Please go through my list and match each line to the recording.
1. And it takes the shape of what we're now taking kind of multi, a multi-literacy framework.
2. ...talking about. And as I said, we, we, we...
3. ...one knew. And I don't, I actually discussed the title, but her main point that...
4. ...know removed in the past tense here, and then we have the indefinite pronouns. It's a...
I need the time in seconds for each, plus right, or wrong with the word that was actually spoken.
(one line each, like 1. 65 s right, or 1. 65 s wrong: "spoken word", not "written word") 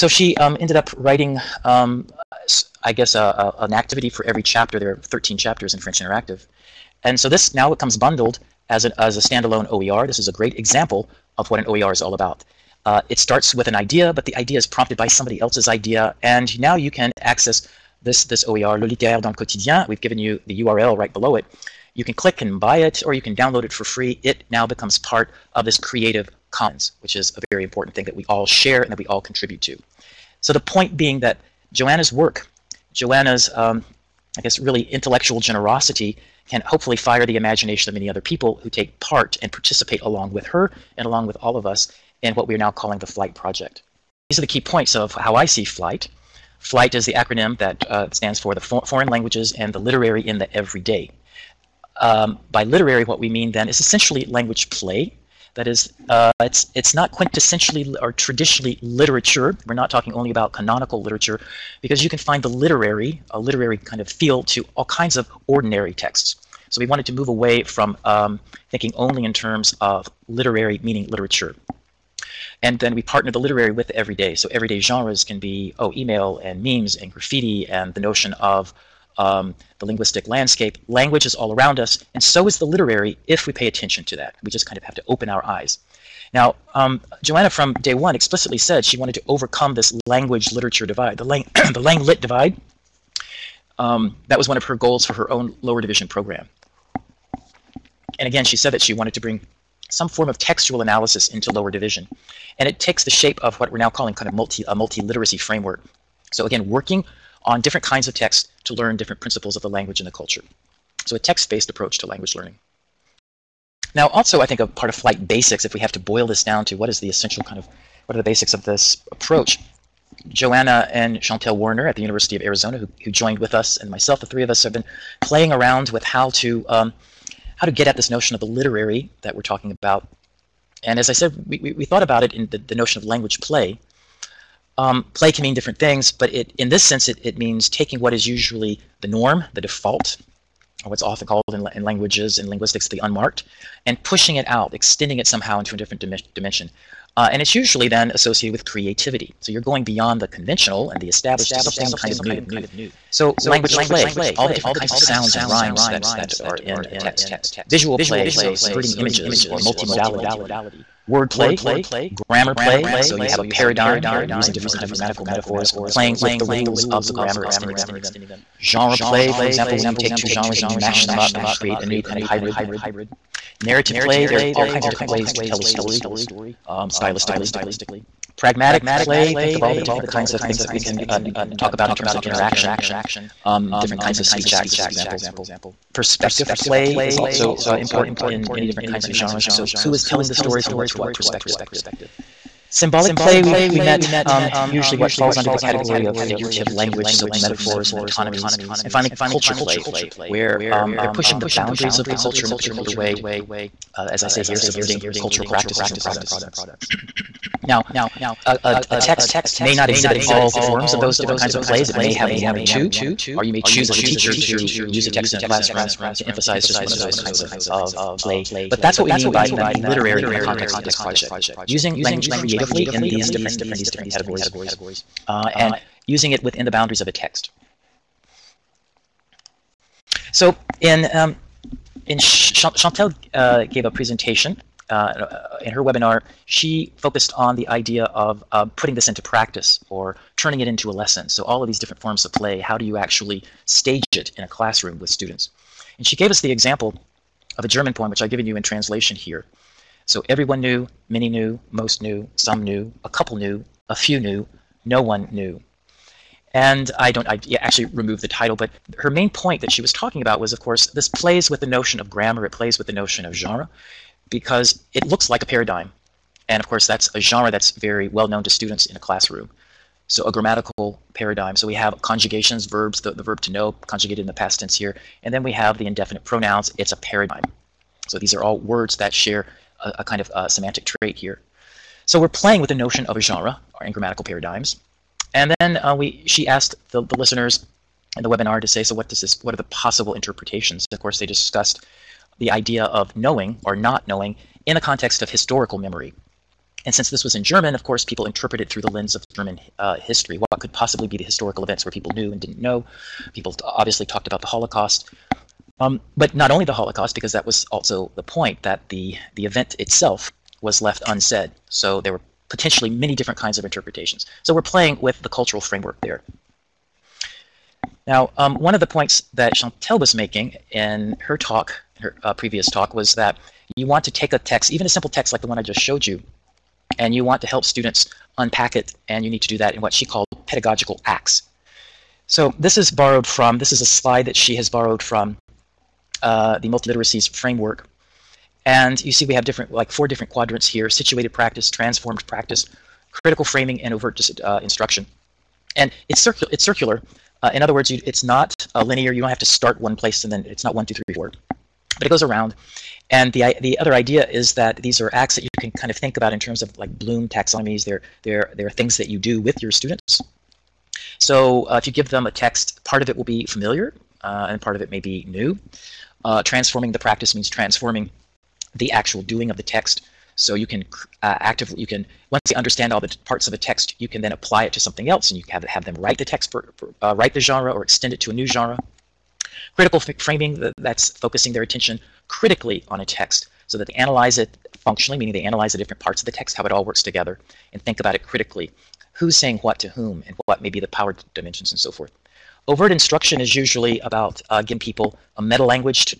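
1. 102 s wrong: "calling", not "taking"
2. 129 s right
3. 255 s wrong: "removed", not "discussed"
4. 273 s wrong: "conjugated", not "removed".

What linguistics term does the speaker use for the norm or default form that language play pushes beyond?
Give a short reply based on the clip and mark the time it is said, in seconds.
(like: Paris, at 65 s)
the unmarked, at 142 s.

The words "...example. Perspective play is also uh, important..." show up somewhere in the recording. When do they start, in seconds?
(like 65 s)
184 s.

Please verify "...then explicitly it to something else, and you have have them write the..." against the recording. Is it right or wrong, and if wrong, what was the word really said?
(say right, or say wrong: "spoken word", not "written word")
wrong: "apply", not "explicitly".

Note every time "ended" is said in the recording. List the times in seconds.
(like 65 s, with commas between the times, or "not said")
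0 s.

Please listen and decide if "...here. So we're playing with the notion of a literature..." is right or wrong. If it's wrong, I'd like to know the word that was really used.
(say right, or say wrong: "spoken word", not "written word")
wrong: "genre", not "literature".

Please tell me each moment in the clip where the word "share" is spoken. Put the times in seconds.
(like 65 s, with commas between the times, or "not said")
28 s, 279 s.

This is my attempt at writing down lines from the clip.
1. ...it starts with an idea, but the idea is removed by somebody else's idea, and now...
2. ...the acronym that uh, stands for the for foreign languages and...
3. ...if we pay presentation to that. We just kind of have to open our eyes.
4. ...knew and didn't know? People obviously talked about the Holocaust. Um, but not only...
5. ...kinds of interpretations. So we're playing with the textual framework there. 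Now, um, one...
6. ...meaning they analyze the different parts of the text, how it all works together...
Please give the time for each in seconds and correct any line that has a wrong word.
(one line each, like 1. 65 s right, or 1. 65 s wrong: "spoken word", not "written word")
1. 13 s wrong: "prompted", not "removed"
2. 47 s right
3. 83 s wrong: "attention", not "presentation"
4. 302 s right
5. 313 s wrong: "cultural", not "textual"
6. 385 s right.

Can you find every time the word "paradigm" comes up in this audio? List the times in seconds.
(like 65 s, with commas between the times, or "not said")
163 s, 265 s, 271 s, 276 s, 284 s.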